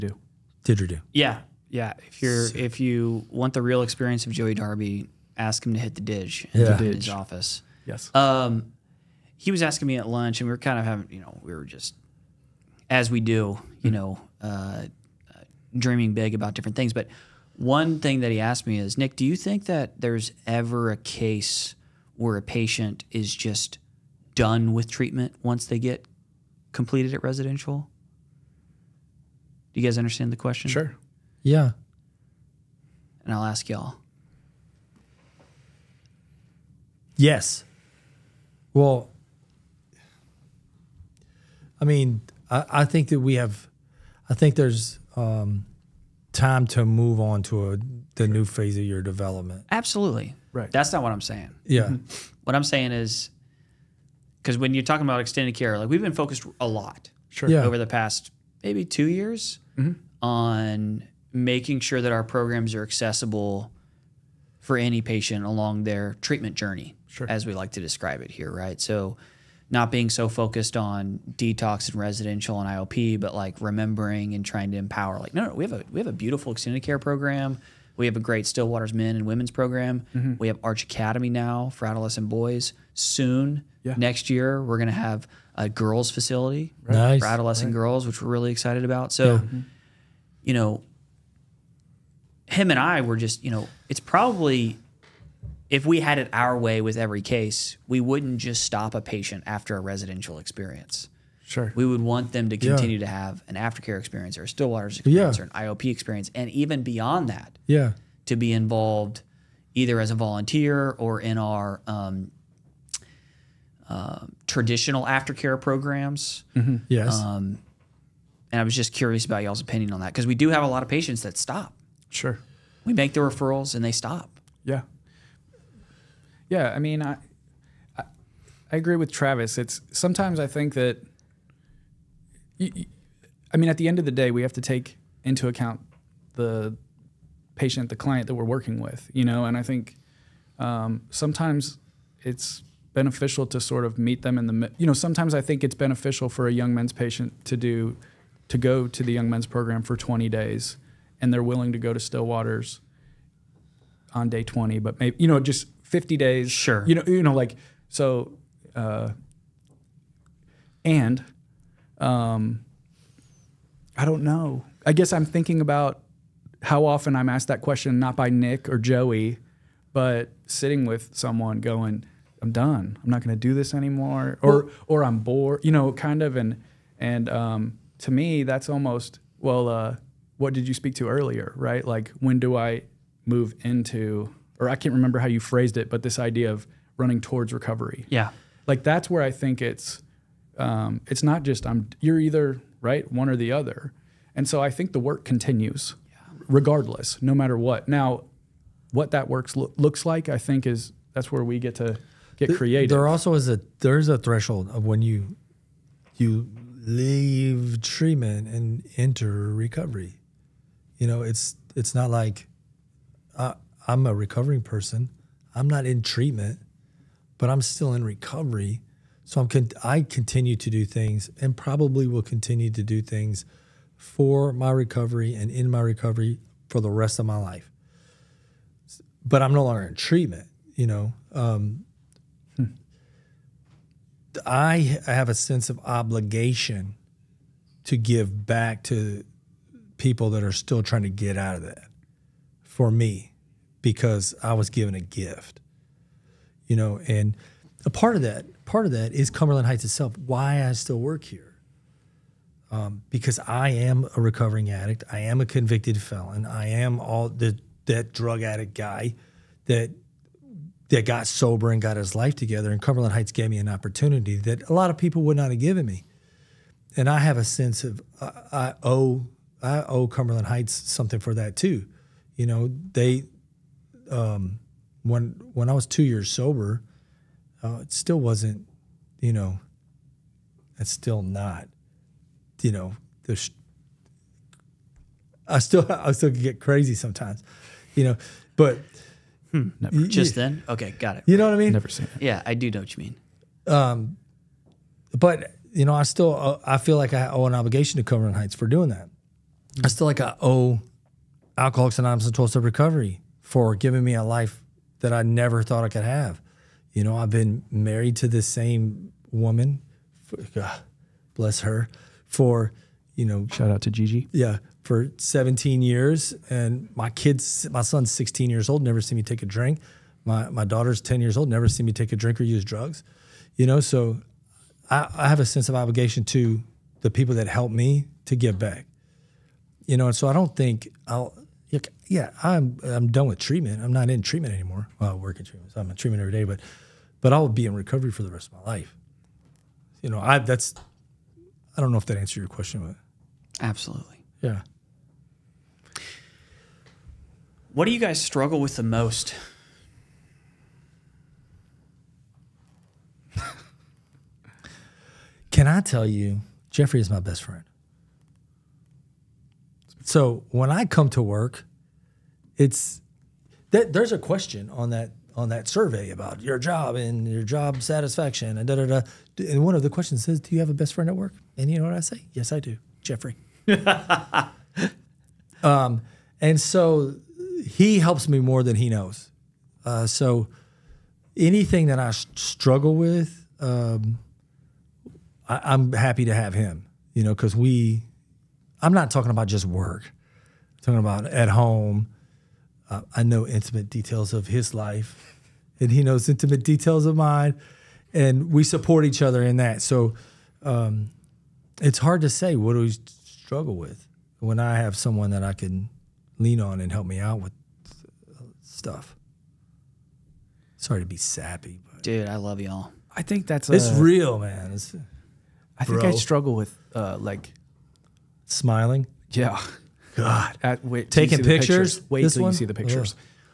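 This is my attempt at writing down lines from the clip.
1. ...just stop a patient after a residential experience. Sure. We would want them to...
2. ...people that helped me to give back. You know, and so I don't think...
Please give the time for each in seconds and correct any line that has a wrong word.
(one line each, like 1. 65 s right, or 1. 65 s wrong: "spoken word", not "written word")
1. 98 s right
2. 327 s right.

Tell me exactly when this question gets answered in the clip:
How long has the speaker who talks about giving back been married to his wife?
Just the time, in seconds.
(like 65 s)
315 s.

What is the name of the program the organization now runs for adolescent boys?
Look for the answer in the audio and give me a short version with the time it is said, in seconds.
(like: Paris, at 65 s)
Arch Academy, at 80 s.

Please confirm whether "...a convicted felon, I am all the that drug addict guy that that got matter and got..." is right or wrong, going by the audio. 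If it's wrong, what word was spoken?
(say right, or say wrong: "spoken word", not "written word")
wrong: "sober", not "matter".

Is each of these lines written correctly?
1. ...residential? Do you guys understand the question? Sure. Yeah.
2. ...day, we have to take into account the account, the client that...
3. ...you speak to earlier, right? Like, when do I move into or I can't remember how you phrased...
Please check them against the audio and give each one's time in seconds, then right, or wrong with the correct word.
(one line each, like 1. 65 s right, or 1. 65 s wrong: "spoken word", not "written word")
1. 27 s right
2. 134 s wrong: "patient", not "account"
3. 180 s right.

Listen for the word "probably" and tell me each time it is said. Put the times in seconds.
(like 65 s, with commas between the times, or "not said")
94 s, 221 s.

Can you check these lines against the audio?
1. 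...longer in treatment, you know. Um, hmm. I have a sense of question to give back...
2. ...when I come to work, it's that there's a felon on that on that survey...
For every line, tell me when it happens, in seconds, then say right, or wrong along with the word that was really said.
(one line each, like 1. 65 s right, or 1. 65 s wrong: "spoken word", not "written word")
1. 229 s wrong: "obligation", not "question"
2. 360 s wrong: "question", not "felon".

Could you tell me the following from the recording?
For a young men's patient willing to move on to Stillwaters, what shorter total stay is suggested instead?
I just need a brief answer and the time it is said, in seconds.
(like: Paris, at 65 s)
50 days, at 155 s.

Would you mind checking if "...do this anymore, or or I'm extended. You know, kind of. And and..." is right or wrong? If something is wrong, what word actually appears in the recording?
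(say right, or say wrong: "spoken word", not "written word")
wrong: "bored", not "extended".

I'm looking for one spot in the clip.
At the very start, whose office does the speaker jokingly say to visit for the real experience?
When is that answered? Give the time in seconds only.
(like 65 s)
4 s.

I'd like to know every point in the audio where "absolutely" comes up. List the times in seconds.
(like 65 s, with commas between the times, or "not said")
49 s, 343 s.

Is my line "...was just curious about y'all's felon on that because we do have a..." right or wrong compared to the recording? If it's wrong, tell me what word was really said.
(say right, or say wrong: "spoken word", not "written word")
wrong: "opinion", not "felon".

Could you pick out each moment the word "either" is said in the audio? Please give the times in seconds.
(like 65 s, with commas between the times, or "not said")
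109 s, 192 s.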